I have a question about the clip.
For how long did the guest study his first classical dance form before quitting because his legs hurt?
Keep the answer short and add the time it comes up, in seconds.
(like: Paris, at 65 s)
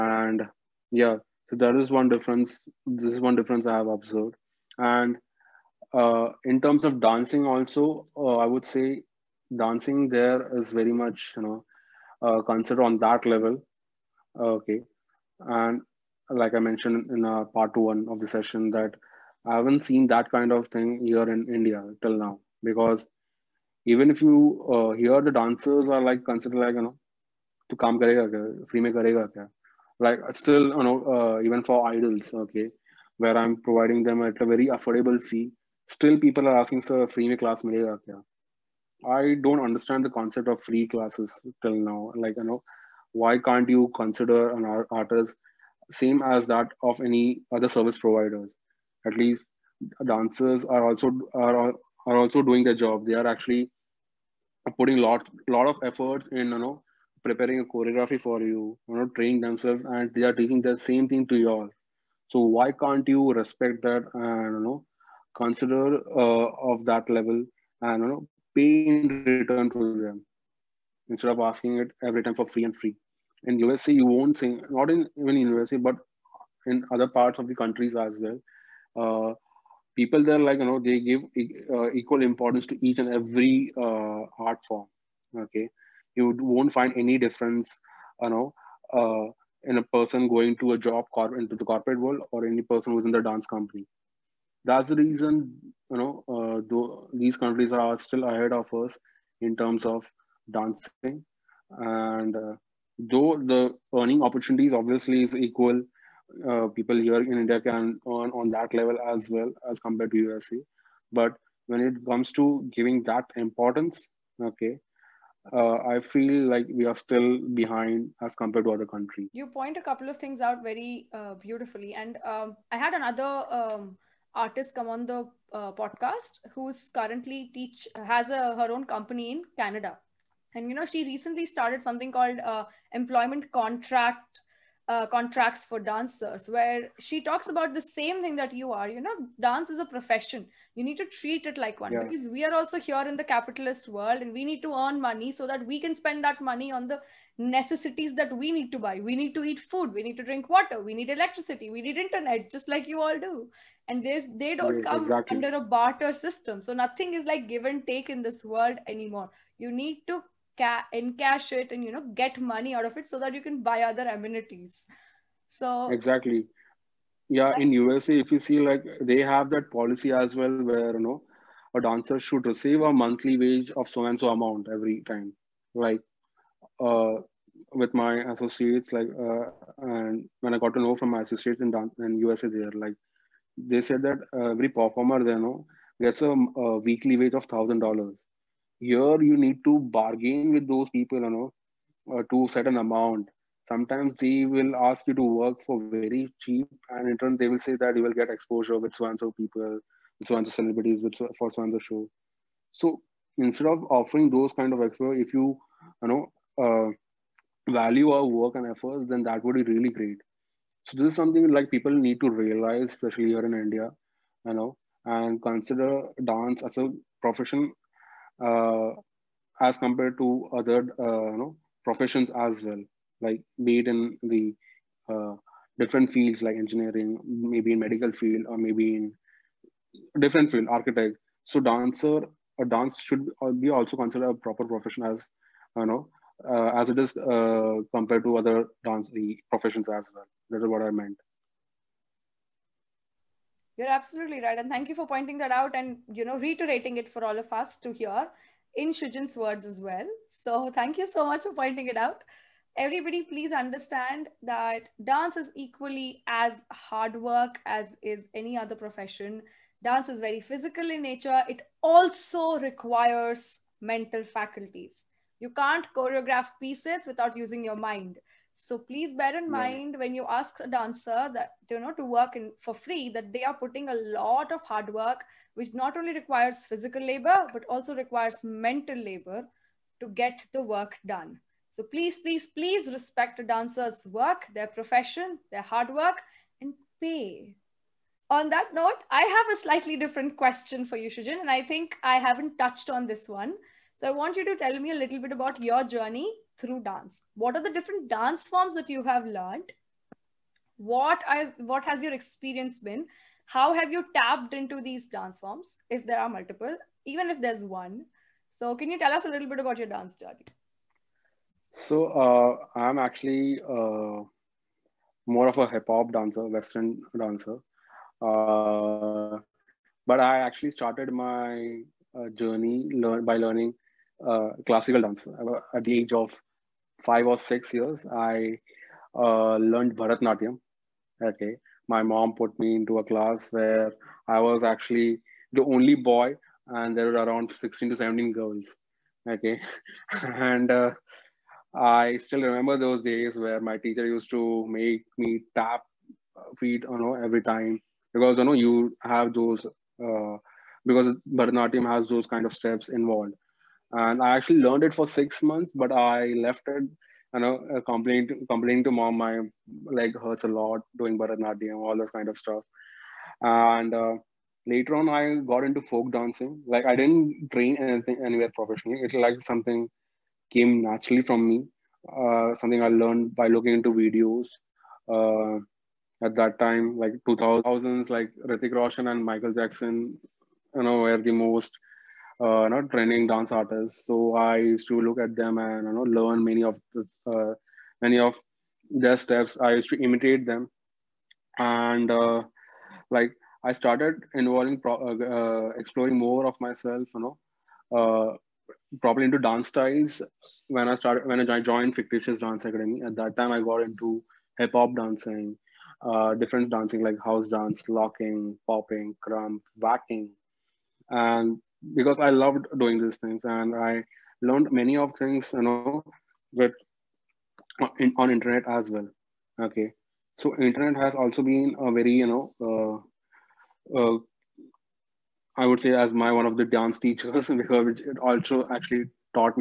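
6 months, at 355 s.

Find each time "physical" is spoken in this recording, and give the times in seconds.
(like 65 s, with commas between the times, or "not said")
260 s, 276 s.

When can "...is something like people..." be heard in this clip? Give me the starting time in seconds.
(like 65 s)
211 s.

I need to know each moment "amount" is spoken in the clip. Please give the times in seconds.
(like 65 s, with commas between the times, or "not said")
174 s, 192 s.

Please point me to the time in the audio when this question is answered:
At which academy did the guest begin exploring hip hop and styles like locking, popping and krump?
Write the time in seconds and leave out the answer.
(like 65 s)
401 s.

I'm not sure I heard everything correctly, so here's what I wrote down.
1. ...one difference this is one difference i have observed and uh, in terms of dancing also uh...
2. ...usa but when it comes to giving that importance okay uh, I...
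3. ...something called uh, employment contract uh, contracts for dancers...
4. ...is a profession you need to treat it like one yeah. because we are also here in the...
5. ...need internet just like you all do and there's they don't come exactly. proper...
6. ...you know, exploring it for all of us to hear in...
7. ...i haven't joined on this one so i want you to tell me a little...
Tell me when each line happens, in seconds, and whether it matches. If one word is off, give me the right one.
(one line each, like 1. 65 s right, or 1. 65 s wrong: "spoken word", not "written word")
1. 1 s right
2. 110 s right
3. 131 s right
4. 139 s right
5. 151 s wrong: "under", not "proper"
6. 246 s wrong: "reiterating", not "exploring"
7. 292 s wrong: "touched", not "joined".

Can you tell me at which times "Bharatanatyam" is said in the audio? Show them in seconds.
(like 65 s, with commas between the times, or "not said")
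329 s, 351 s, 361 s.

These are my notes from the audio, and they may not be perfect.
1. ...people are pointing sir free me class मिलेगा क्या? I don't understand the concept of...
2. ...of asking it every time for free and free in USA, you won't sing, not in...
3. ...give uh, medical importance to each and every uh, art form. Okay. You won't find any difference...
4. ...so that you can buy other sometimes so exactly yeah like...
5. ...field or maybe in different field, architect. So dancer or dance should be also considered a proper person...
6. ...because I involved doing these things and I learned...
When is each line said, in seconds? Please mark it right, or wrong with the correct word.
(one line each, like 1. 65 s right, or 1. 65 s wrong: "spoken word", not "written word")
1. 36 s wrong: "asking", not "pointing"
2. 71 s right
3. 80 s wrong: "equal", not "medical"
4. 163 s wrong: "amenities", not "sometimes"
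5. 228 s wrong: "profession", not "person"
6. 411 s wrong: "loved", not "involved".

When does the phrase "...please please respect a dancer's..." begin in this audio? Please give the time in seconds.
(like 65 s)
282 s.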